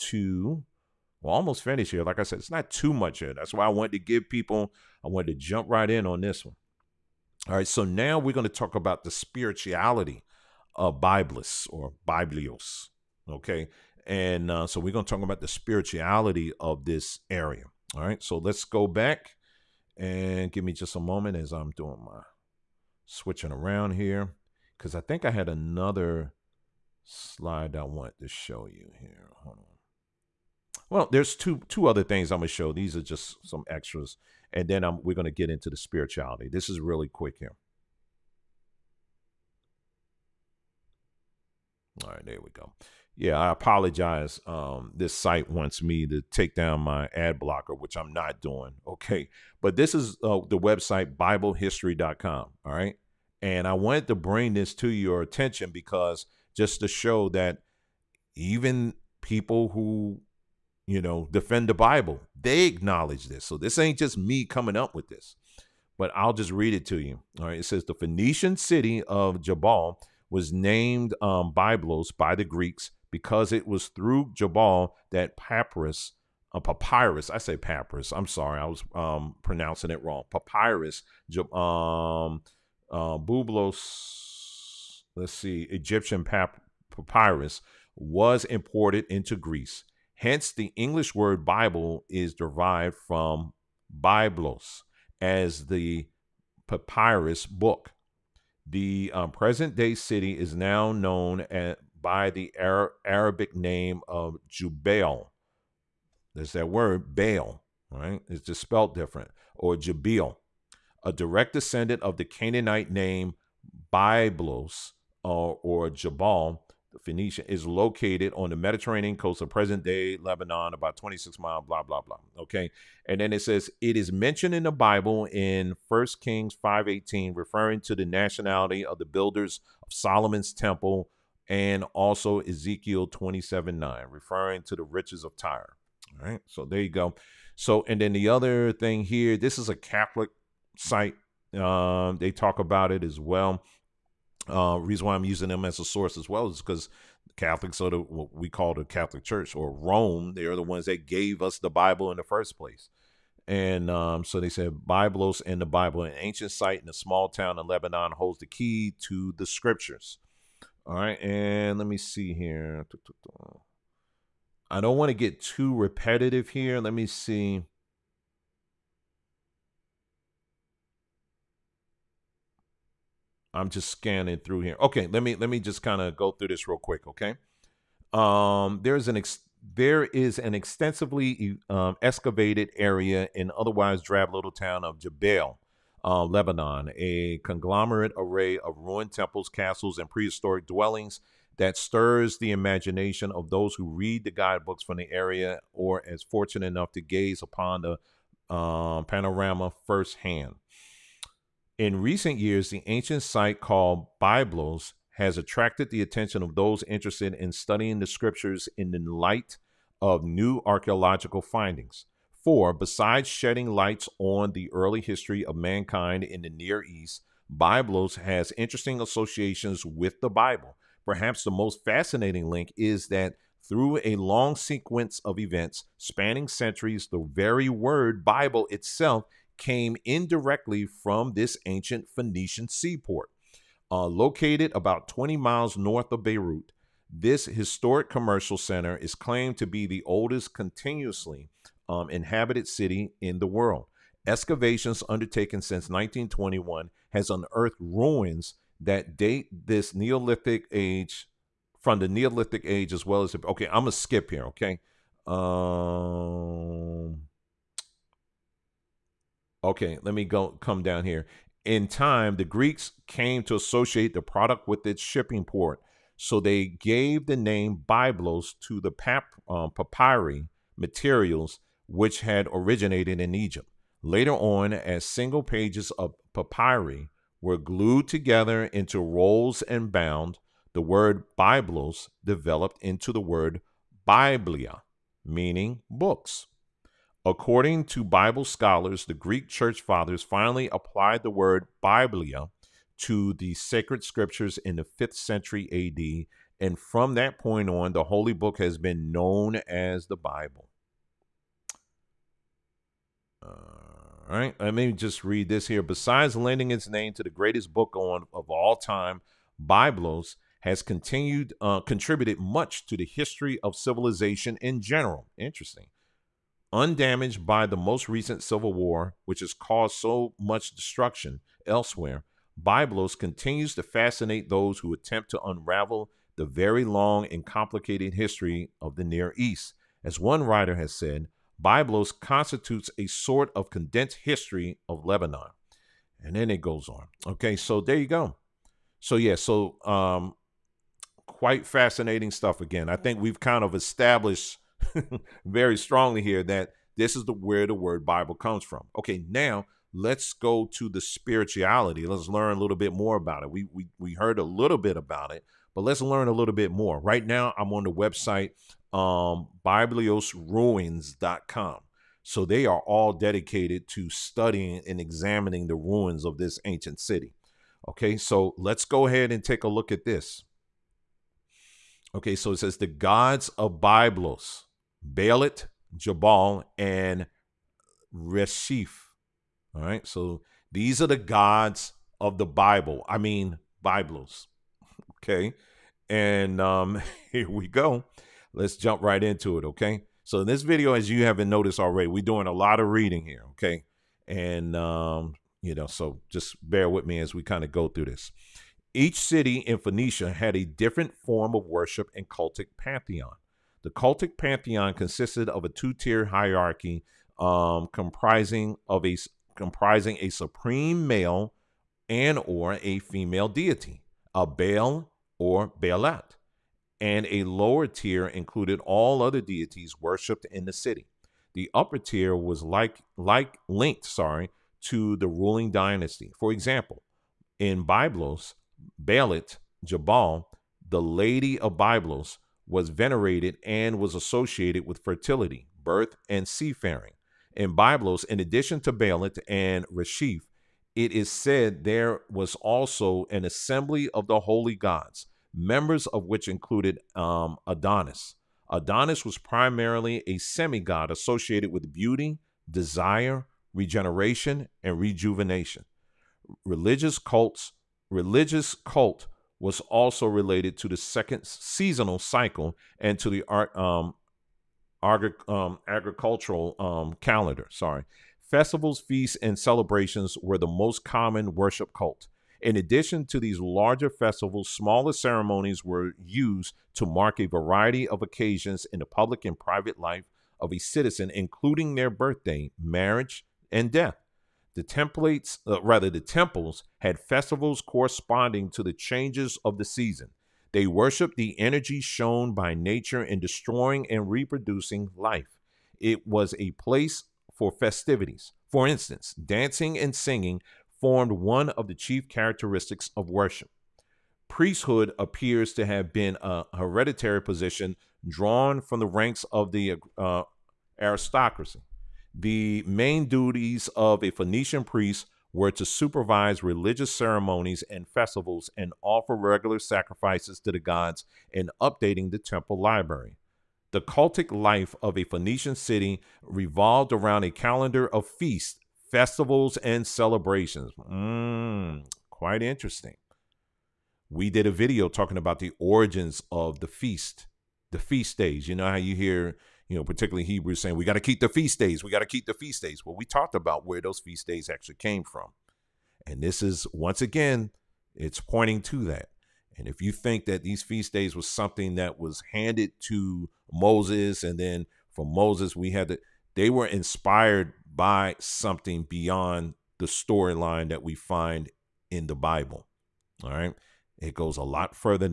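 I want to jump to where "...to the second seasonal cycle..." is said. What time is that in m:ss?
7:40.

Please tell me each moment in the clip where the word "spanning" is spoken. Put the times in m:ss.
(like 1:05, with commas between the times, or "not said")
3:45.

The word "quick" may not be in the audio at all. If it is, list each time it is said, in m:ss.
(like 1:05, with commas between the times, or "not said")
0:37, 2:56.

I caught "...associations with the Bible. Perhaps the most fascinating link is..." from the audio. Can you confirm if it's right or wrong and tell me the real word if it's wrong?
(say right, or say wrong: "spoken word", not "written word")
right.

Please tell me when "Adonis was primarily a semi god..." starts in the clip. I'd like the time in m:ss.
7:28.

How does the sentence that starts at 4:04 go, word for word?
Excavations undertaken since 1921 has unearthed ruins that date this Neolithic age from the Neolithic age as well as the, okay.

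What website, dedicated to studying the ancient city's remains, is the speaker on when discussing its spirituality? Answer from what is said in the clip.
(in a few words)
ByblosRuins.com.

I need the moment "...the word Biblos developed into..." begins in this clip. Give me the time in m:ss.
4:40.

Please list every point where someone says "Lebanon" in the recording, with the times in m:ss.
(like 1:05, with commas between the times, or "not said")
2:00, 2:37, 3:06, 5:35.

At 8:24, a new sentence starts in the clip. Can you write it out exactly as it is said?
Priesthood appears to have been a hereditary position drawn from the ranks of the uh, aristocracy.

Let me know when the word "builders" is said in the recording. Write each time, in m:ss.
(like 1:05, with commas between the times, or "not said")
2:09.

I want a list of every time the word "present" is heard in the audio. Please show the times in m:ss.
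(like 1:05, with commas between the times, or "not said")
1:39, 1:59.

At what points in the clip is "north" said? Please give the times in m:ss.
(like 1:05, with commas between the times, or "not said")
3:55.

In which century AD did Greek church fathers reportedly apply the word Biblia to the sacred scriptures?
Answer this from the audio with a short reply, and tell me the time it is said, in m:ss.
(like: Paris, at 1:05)
5th century, at 4:54.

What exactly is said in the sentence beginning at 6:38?
Each city in Phoenicia had a different form of worship and cultic pantheon.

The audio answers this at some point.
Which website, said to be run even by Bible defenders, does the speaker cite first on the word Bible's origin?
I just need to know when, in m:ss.
0:51.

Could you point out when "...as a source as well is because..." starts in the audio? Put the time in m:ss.
2:25.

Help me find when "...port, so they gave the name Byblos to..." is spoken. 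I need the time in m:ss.
4:25.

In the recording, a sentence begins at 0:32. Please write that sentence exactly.
These are just some extras, and then I'm, we're gonna get into the spirituality.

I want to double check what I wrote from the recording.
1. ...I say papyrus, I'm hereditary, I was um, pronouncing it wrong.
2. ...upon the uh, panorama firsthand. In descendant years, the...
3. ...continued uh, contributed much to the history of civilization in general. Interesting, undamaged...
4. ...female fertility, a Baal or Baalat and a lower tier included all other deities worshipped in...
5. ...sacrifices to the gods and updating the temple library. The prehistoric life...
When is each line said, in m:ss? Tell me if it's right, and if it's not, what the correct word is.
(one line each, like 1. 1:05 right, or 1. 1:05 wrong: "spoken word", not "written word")
1. 1:17 wrong: "sorry", not "hereditary"
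2. 3:17 wrong: "recent", not "descendant"
3. 5:10 right
4. 6:53 wrong: "deity", not "fertility"
5. 8:39 wrong: "cultic", not "prehistoric".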